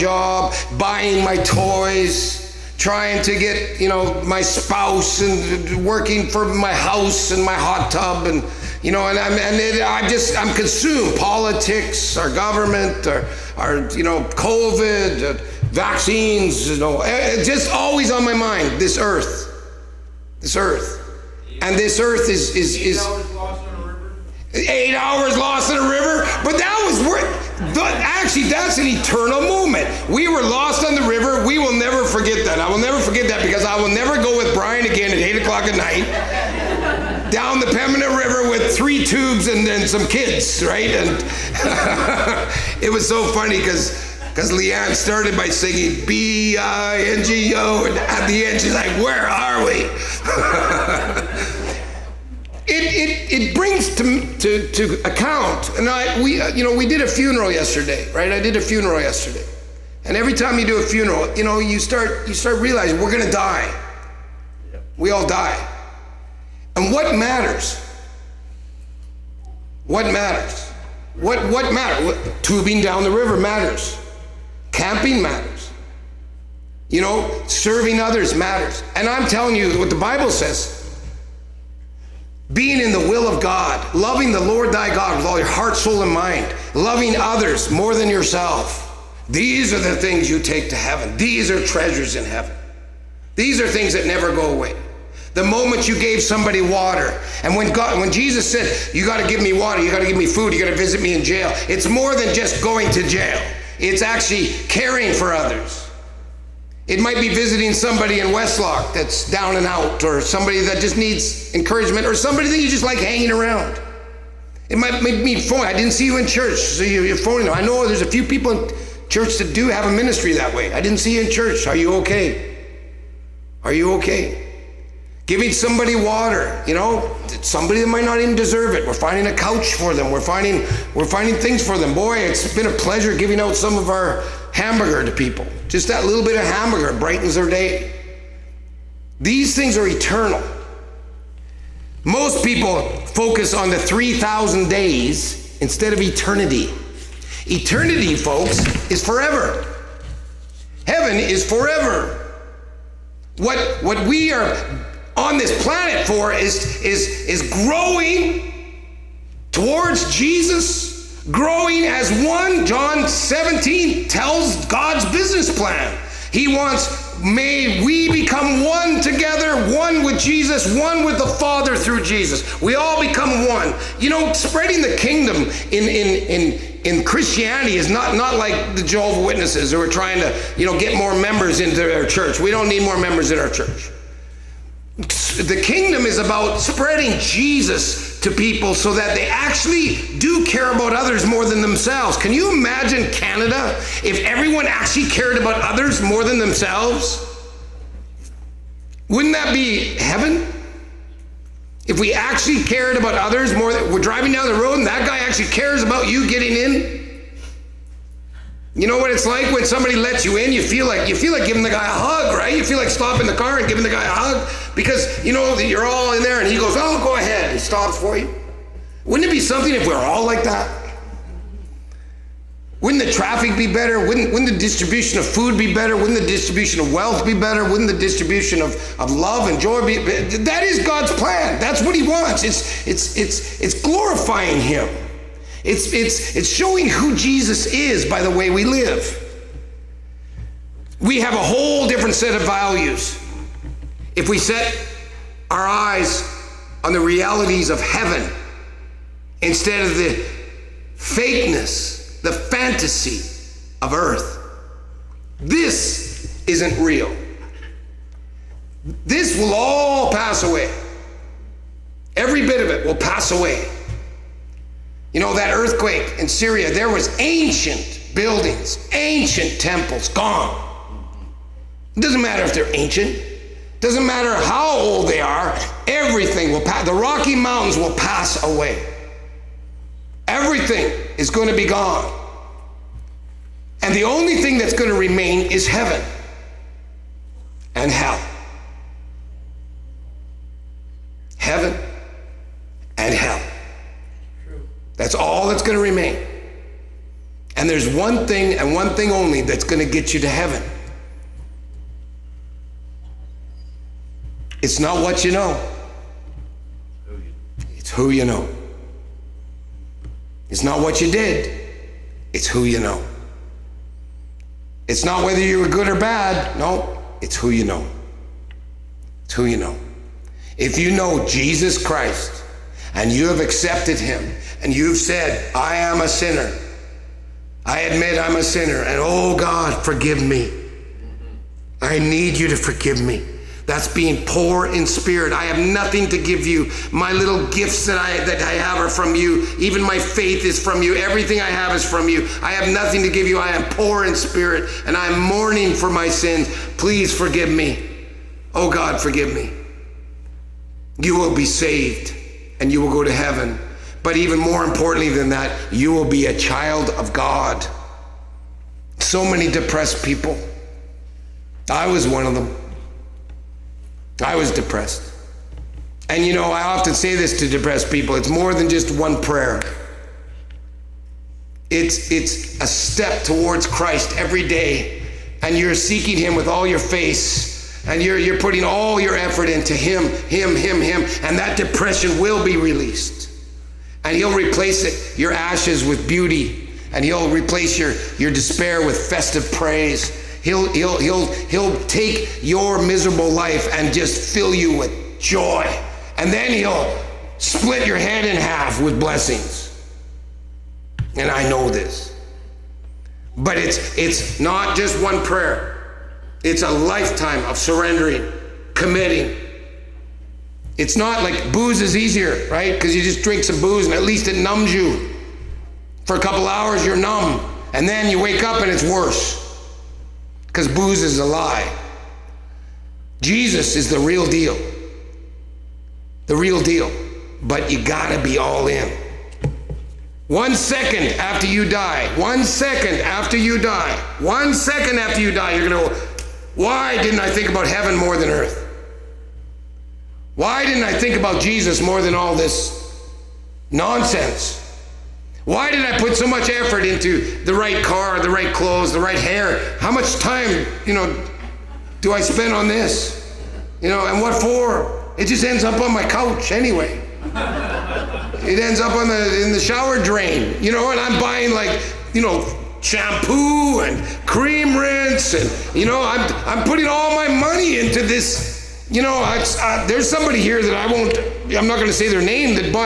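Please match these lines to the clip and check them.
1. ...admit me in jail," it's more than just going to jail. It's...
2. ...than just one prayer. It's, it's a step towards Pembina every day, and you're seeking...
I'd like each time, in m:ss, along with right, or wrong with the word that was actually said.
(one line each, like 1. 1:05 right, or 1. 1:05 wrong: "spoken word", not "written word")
1. 1:40 wrong: "visit", not "admit"
2. 6:08 wrong: "Christ", not "Pembina".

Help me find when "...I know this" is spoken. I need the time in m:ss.
6:41.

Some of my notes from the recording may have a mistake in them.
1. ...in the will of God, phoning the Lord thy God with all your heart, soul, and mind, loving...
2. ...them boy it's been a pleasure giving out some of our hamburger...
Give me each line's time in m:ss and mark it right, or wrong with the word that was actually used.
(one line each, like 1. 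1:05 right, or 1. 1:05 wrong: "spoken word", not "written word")
1. 1:22 wrong: "loving", not "phoning"
2. 2:11 right.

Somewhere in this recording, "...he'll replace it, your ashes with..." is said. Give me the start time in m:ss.
6:24.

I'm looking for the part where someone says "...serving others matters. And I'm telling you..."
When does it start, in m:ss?
1:17.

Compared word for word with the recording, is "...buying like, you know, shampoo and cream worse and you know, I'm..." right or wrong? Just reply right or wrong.
wrong.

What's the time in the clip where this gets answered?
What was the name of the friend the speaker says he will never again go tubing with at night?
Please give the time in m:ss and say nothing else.
0:34.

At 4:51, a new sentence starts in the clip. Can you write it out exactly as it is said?
Heaven That's all that's going to remain.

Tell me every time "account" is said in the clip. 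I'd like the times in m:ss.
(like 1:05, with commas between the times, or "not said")
0:55.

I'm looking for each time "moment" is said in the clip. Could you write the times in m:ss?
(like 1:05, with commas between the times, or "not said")
0:29, 1:35.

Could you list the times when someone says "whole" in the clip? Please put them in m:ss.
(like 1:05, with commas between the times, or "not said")
4:01.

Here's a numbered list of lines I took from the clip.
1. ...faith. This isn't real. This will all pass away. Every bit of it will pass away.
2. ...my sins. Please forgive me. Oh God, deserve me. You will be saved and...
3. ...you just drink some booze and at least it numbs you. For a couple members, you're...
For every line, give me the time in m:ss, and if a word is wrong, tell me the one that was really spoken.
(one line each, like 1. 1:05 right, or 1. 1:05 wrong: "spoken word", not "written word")
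1. 4:13 wrong: "earth", not "faith"
2. 5:45 wrong: "forgive", not "deserve"
3. 6:52 wrong: "hours", not "members".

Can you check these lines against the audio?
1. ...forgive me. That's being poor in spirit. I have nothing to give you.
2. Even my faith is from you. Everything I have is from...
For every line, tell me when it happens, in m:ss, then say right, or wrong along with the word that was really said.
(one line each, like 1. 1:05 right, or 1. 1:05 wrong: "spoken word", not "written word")
1. 5:32 right
2. 5:39 right.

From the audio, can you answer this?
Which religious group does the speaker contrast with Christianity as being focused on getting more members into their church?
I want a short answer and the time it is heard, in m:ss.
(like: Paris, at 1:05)
Jehovah's Witnesses, at 2:58.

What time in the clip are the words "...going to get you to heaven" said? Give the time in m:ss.
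4:59.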